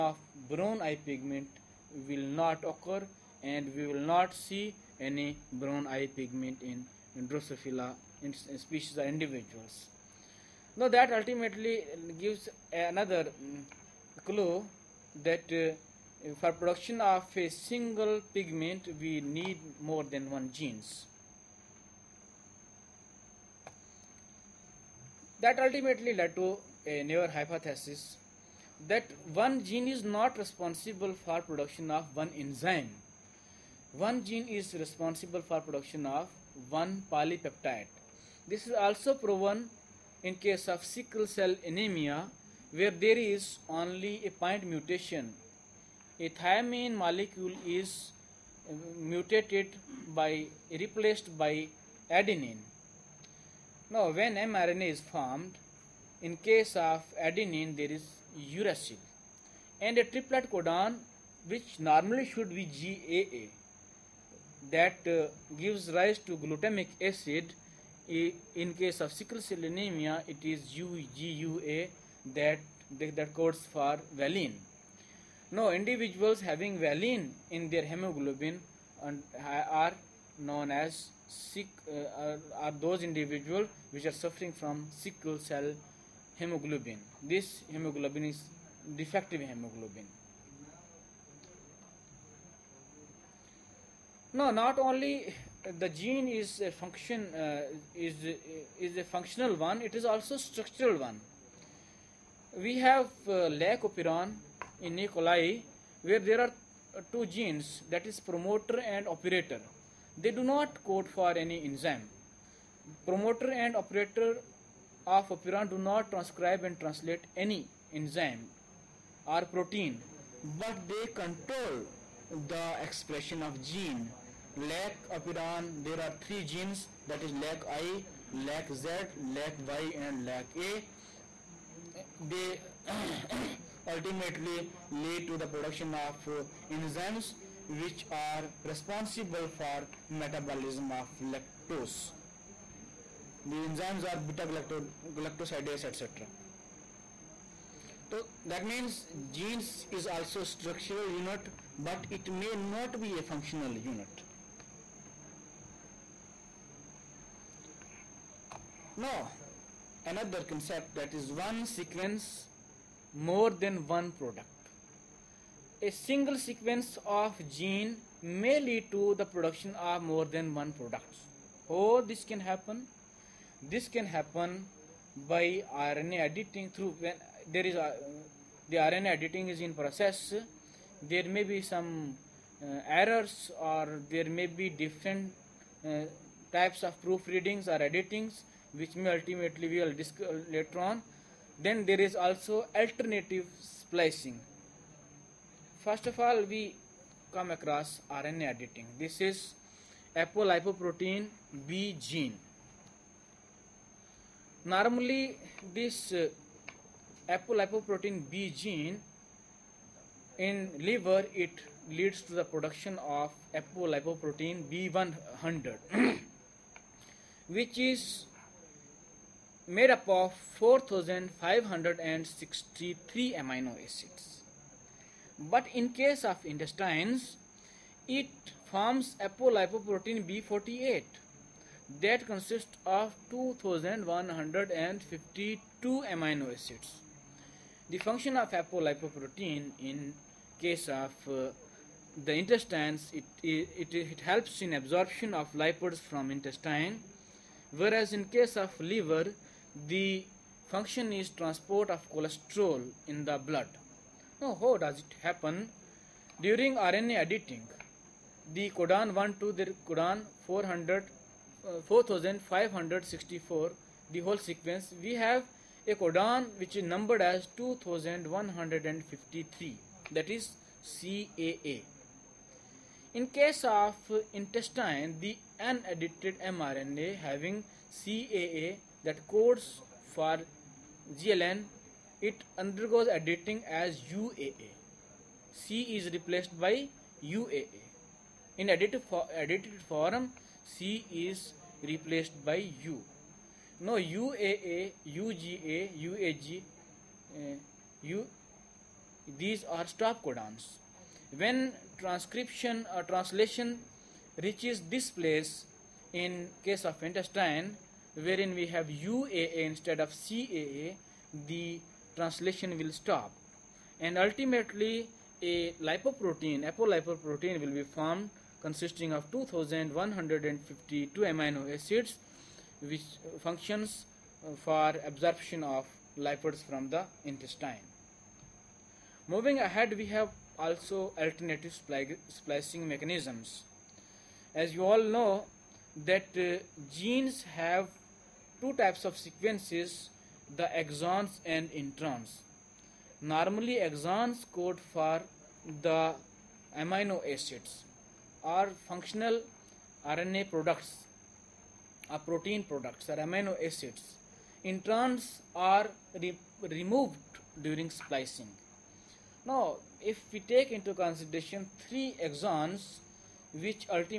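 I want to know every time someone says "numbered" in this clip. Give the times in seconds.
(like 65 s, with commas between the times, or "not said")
266 s.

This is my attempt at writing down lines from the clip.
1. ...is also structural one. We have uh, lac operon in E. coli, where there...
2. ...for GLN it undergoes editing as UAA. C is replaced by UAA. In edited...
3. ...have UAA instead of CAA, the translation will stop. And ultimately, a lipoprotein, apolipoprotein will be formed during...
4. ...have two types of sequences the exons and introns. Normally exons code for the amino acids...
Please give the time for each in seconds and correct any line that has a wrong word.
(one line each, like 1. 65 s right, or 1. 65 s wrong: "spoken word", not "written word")
1. 99 s right
2. 280 s right
3. 308 s wrong: "consisting", not "during"
4. 337 s right.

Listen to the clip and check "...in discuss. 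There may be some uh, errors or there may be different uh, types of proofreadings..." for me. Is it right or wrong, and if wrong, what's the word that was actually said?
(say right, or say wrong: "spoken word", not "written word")
wrong: "process", not "discuss".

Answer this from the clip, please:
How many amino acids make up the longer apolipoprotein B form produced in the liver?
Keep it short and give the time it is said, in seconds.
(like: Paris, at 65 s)
4563, at 220 s.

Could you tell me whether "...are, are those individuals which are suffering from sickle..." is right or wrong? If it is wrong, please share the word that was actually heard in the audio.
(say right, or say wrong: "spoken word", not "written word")
right.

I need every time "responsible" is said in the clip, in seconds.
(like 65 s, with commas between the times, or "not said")
30 s, 34 s, 138 s.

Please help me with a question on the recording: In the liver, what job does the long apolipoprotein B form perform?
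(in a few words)
transport of cholesterol.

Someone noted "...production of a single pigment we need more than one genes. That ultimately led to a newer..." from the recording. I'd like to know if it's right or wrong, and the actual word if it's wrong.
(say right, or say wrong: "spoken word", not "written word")
right.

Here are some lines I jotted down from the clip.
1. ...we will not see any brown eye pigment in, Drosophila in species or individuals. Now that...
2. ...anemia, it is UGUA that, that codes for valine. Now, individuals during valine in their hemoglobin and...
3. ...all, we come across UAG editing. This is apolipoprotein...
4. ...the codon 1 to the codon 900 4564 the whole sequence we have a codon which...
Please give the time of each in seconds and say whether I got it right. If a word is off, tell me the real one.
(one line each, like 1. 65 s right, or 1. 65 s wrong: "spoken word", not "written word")
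1. 3 s right
2. 69 s wrong: "having", not "during"
3. 196 s wrong: "RNA", not "UAG"
4. 258 s wrong: "400", not "900".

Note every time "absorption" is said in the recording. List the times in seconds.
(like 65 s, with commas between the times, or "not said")
244 s, 325 s.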